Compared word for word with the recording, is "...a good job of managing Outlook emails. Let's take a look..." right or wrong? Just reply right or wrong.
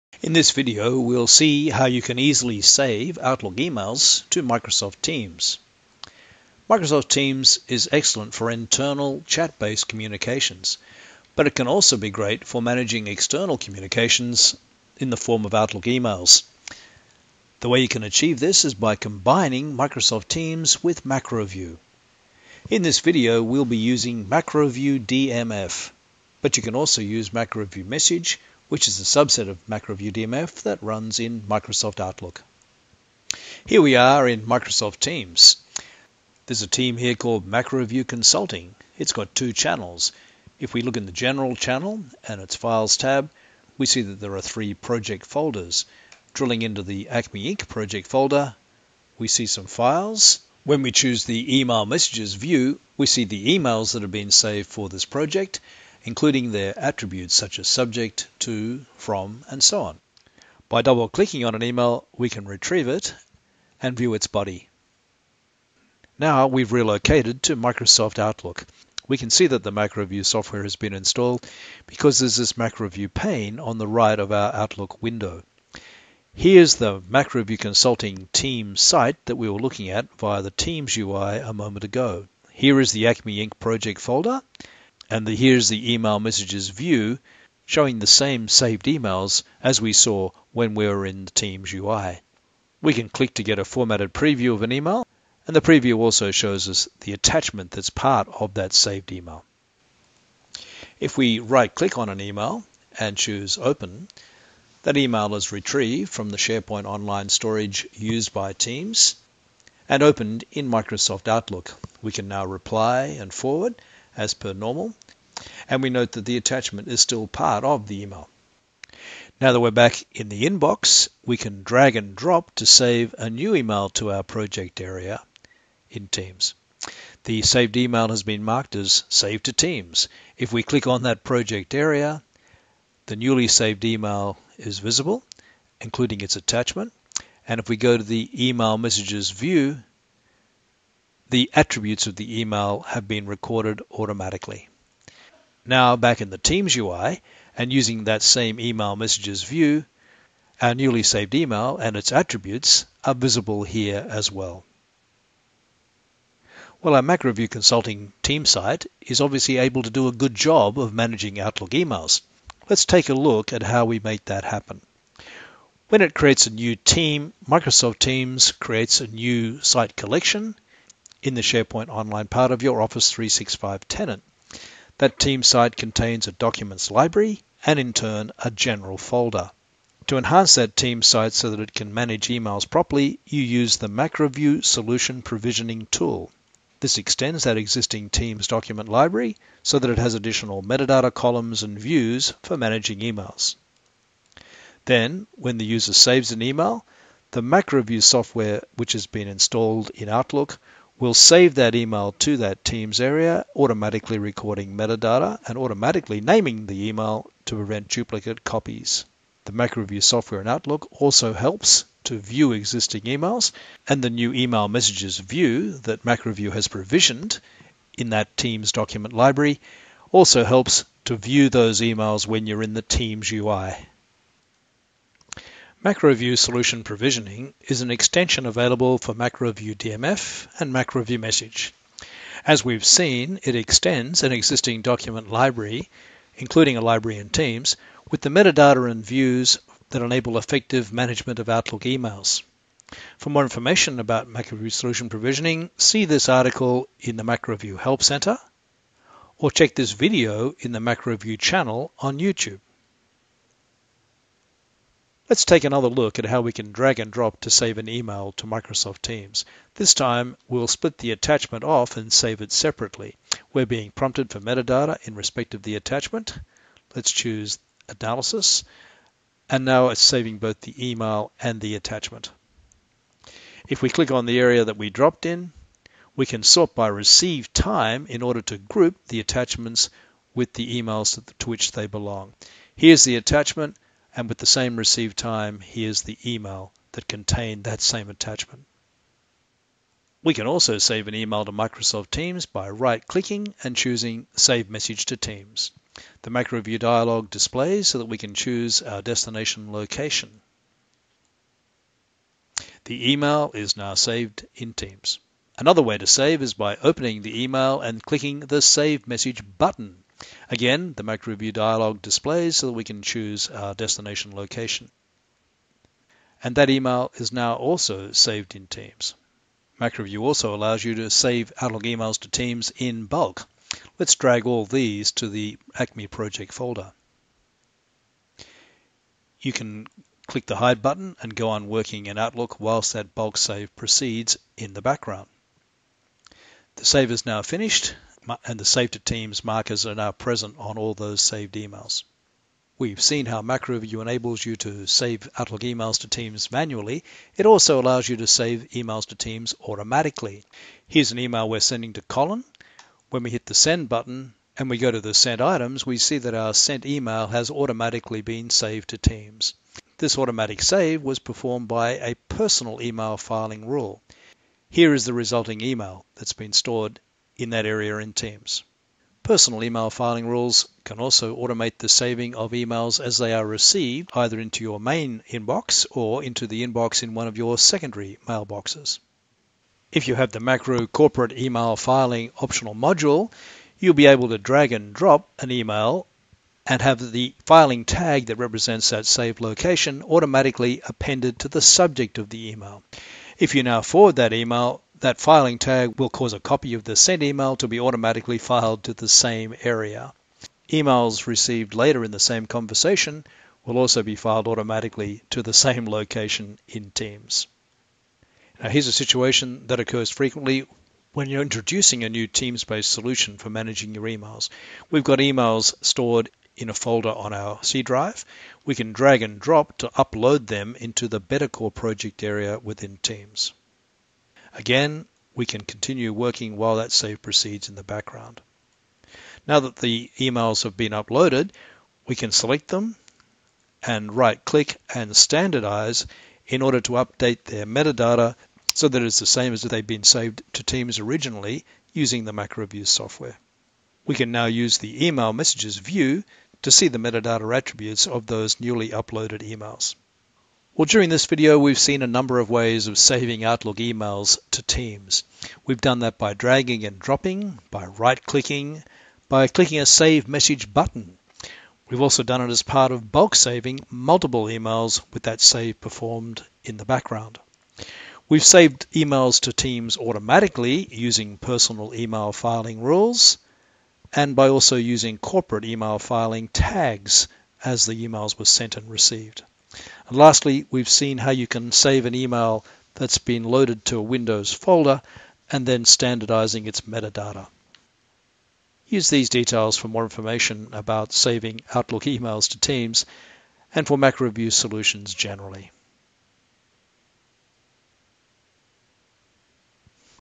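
right.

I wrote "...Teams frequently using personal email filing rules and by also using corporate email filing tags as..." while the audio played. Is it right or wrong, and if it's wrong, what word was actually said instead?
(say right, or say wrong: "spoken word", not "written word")
wrong: "automatically", not "frequently".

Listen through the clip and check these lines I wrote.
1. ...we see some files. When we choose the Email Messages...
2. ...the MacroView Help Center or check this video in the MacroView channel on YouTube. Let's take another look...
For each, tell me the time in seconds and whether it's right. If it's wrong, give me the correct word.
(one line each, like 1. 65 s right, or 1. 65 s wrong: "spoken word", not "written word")
1. 49 s right
2. 247 s right.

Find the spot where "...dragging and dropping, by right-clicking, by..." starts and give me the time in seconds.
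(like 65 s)
456 s.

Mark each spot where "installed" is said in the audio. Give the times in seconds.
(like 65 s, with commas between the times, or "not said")
70 s, 199 s.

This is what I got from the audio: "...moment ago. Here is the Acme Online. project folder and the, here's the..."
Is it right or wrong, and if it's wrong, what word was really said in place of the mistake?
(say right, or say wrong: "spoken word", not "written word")
wrong: "Inc", not "Online".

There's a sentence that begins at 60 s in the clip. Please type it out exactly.
By double-clicking on an email, we can retrieve it and view its body.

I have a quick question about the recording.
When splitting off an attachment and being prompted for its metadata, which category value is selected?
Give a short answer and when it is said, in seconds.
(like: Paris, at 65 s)
analysis, at 267 s.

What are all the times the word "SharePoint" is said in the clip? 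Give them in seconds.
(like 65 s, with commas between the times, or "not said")
106 s, 171 s.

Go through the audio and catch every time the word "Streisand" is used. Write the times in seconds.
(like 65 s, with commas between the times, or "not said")
not said.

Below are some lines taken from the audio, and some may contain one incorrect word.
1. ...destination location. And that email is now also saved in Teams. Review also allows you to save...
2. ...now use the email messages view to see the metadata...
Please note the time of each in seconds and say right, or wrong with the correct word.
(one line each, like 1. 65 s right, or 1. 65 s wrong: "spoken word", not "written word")
1. 313 s right
2. 444 s right.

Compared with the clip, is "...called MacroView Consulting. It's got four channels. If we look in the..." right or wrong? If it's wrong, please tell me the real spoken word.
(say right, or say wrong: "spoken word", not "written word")
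wrong: "two", not "four".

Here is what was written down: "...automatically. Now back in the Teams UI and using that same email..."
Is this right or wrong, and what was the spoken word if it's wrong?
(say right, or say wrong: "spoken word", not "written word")
right.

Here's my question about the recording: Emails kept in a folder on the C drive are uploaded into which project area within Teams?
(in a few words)
Bettercore.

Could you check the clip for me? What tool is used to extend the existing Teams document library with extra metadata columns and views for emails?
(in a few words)
MacroView Solution Provisioning tool.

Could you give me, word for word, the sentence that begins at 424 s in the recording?
Again, we can continue working while that save proceeds in the background.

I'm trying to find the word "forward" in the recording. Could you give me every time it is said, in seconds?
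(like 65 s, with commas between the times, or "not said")
113 s, 393 s.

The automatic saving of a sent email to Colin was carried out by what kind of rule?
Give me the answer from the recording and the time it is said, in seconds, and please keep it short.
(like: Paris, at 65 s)
personal email filing rule, at 362 s.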